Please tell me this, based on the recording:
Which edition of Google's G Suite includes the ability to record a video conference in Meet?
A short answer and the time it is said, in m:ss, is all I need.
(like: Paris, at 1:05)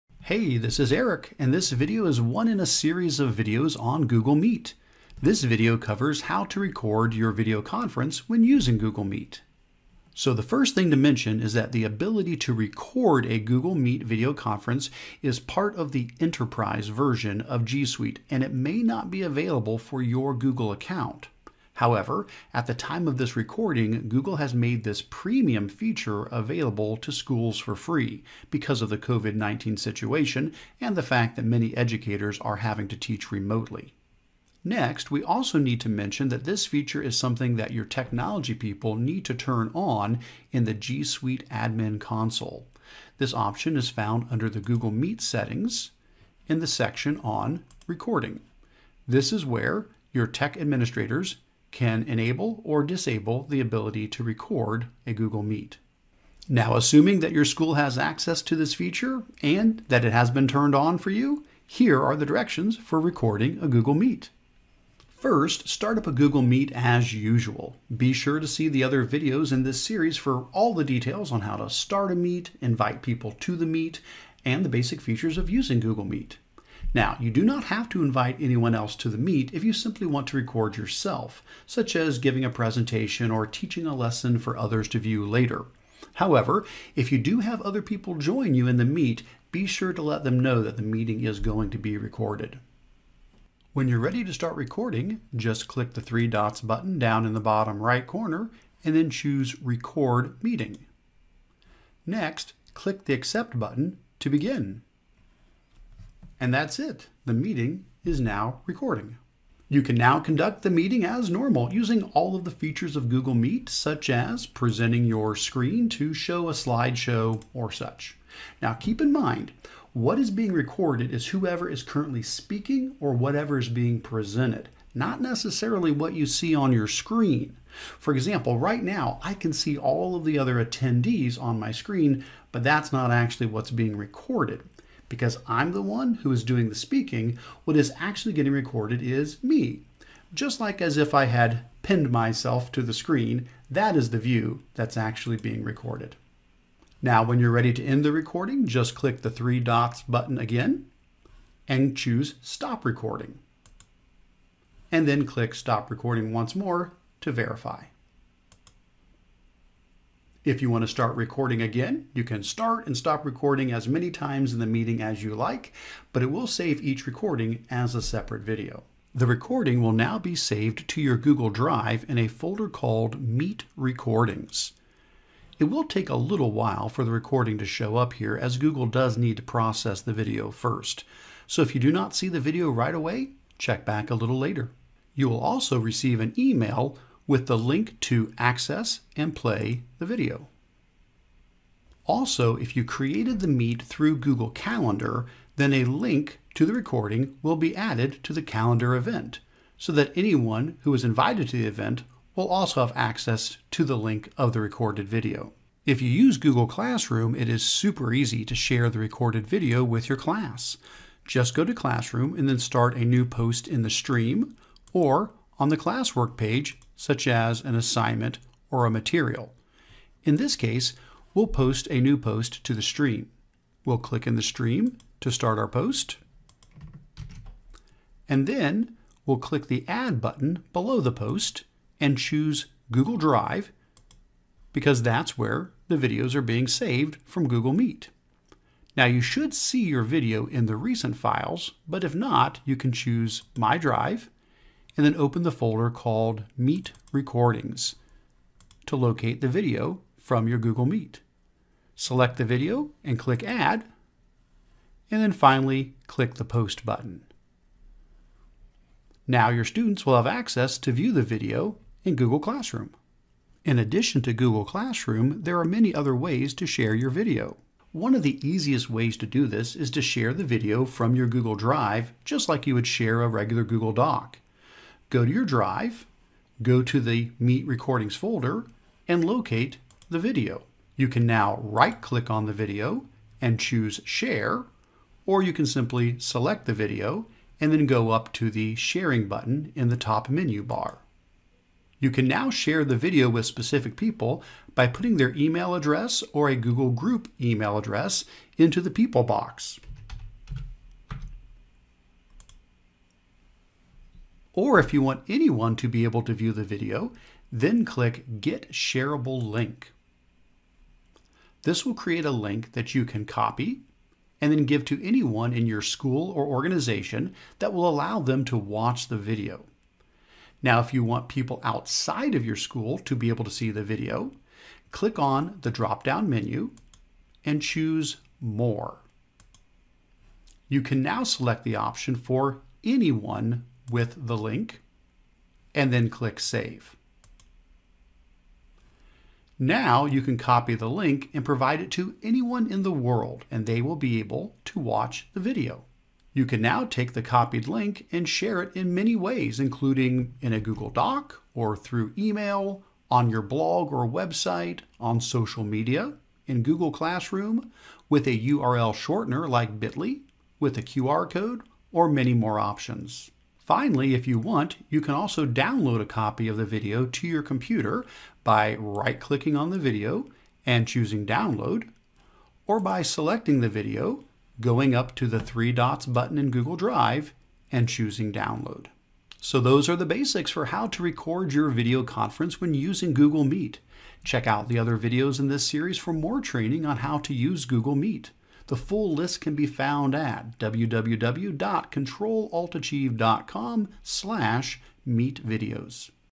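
enterprise version, at 0:16.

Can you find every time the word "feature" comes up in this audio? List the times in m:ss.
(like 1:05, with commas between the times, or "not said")
0:25, 0:36, 0:58, 1:14, 1:52.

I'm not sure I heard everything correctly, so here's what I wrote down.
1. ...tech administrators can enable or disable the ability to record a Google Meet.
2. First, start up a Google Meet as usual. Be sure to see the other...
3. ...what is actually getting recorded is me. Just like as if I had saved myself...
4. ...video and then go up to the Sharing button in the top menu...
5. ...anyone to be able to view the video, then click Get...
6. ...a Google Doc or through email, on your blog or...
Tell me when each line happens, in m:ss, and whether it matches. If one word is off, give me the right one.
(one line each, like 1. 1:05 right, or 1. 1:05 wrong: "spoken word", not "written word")
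1. 0:50 right
2. 1:05 right
3. 2:17 wrong: "pinned", not "saved"
4. 4:46 right
5. 5:05 right
6. 5:50 right.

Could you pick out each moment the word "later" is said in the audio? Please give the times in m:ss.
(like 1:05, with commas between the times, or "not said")
1:25, 3:04.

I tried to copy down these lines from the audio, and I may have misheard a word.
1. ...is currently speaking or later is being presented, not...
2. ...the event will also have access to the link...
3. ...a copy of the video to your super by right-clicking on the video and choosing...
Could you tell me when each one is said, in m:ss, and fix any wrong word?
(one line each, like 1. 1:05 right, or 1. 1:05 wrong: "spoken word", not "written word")
1. 2:01 wrong: "whatever", not "later"
2. 3:21 right
3. 6:06 wrong: "computer", not "super".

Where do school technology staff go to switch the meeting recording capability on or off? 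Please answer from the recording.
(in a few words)
G Suite admin console.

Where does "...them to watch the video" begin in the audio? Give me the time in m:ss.
5:18.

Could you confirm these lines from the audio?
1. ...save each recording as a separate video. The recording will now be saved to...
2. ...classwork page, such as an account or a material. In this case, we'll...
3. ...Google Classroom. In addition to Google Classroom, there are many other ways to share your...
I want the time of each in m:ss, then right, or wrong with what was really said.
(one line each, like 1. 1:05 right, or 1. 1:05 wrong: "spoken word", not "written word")
1. 2:46 right
2. 3:35 wrong: "assignment", not "account"
3. 4:22 right.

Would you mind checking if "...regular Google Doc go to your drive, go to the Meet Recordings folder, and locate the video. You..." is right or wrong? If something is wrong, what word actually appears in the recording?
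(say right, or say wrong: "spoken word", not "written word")
right.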